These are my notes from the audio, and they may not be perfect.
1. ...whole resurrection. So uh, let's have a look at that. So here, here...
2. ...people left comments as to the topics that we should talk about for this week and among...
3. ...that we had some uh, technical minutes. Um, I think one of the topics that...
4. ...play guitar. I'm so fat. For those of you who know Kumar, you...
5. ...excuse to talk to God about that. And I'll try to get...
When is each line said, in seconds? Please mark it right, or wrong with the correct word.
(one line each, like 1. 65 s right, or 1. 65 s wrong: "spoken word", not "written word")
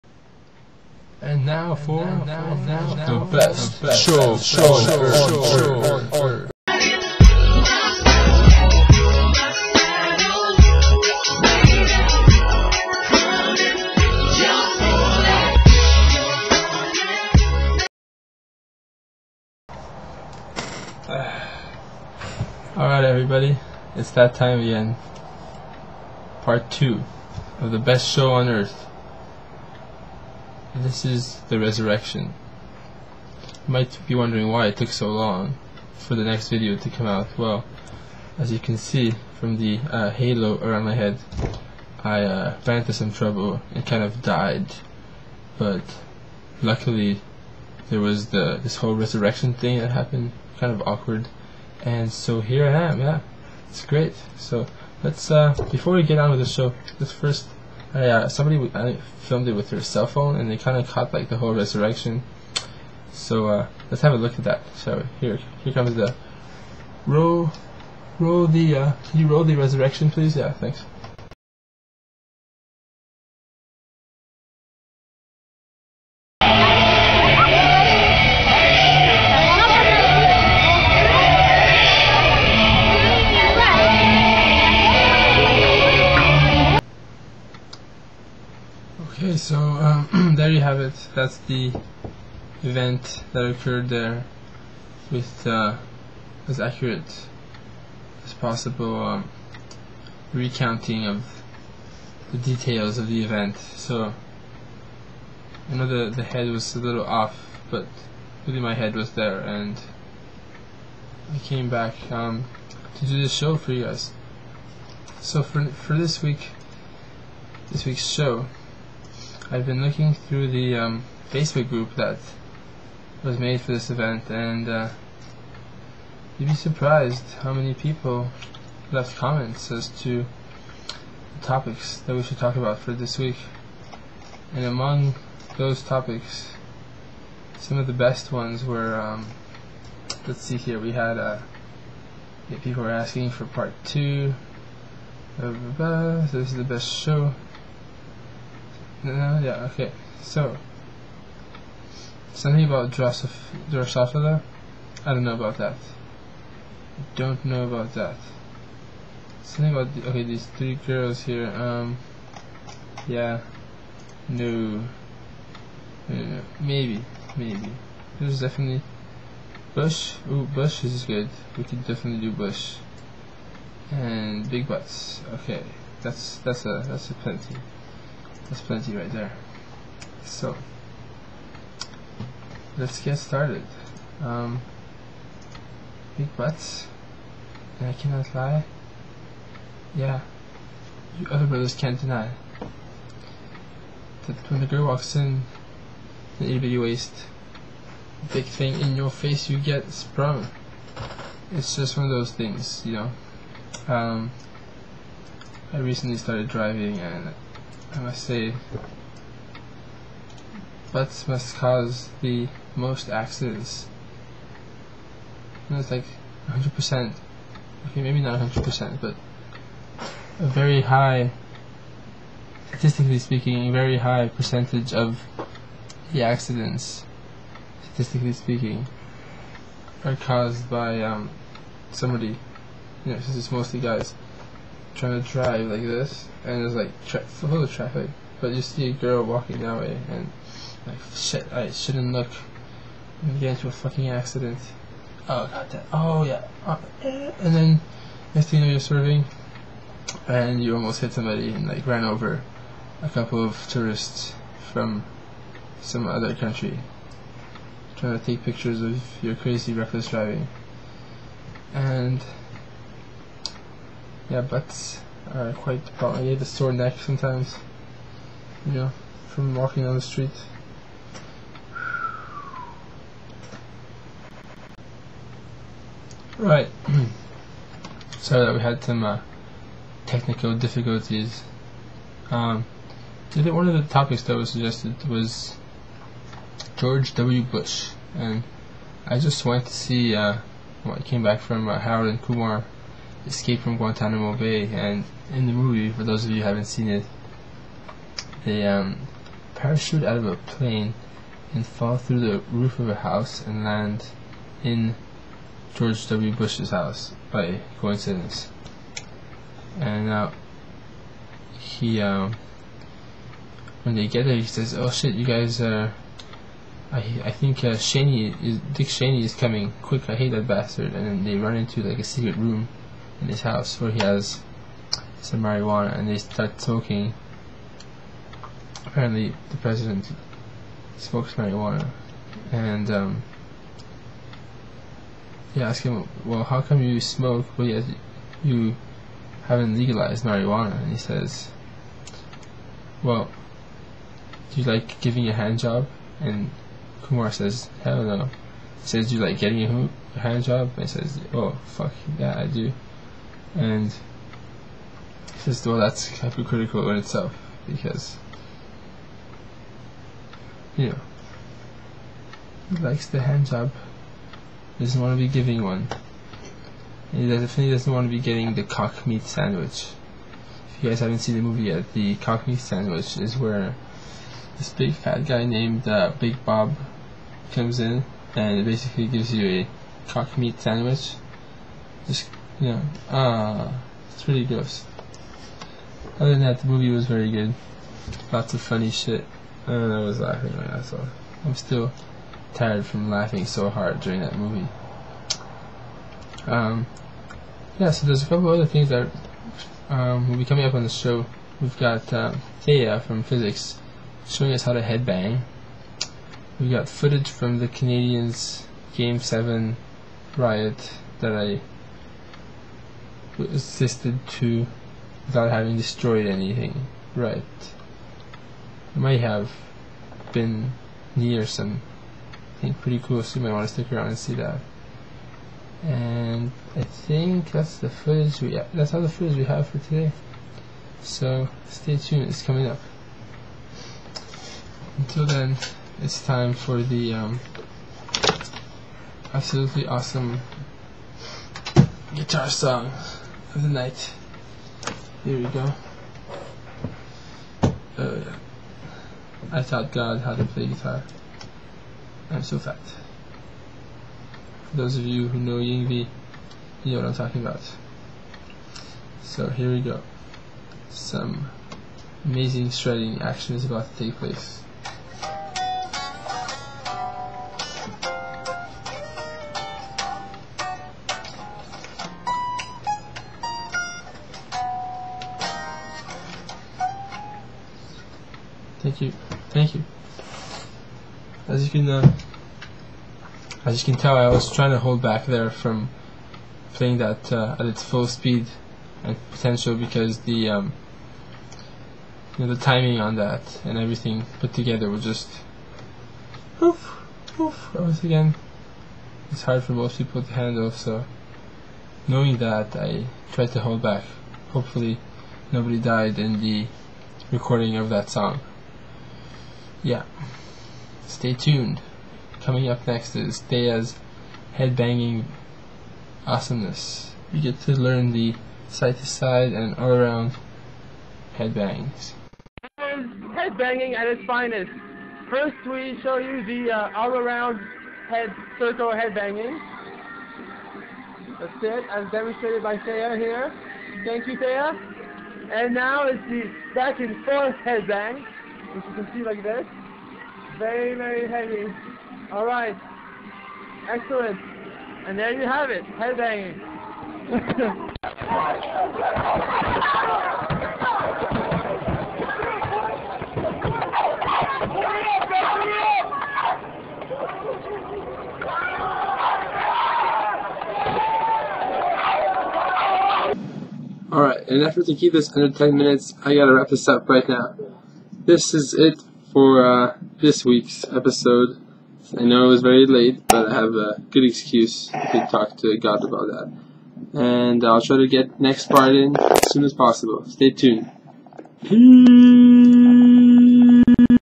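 1. 61 s right
2. 127 s right
3. 278 s wrong: "difficulties", not "minutes"
4. 450 s wrong: "Yngwie", not "Kumar"
5. 574 s right.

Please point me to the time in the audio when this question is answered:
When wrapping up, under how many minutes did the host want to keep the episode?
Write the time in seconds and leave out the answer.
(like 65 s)
565 s.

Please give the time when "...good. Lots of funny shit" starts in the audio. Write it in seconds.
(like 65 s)
387 s.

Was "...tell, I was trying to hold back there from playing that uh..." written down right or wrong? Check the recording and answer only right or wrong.
right.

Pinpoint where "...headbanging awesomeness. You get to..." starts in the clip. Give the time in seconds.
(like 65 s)
514 s.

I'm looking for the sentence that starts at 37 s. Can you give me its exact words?
Well, as you can see from the uh, halo around my head, I uh, ran into some trouble and kind of died.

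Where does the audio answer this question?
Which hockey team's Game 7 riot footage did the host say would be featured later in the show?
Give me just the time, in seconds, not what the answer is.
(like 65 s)
407 s.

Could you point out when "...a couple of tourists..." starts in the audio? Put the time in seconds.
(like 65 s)
253 s.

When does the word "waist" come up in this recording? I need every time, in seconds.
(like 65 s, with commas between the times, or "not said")
196 s.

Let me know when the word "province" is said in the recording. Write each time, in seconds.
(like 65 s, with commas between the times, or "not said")
not said.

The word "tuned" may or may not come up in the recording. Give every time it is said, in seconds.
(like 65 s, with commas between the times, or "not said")
431 s, 511 s, 580 s.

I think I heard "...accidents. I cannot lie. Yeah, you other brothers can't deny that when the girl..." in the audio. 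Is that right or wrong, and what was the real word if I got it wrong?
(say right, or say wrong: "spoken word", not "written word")
wrong: "butts", not "accidents".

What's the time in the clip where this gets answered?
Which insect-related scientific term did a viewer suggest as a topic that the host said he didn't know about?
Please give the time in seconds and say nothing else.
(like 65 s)
153 s.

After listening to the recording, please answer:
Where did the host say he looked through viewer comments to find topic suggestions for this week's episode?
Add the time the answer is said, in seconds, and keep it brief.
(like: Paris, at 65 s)
Facebook group, at 121 s.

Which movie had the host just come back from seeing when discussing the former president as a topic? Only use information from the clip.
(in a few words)
Harold and Kumar Escape from Guantanamo Bay.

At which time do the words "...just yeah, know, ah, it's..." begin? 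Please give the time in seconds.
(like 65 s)
382 s.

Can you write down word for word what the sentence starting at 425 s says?
And I think that's the footage we that's all the footage we have for today.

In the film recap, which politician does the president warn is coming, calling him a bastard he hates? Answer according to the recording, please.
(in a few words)
Dick Cheney.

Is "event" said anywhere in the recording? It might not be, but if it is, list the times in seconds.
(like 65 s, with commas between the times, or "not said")
92 s, 103 s, 123 s.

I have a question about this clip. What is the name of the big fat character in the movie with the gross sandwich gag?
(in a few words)
Big Bob.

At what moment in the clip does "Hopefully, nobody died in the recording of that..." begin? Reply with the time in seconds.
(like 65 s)
504 s.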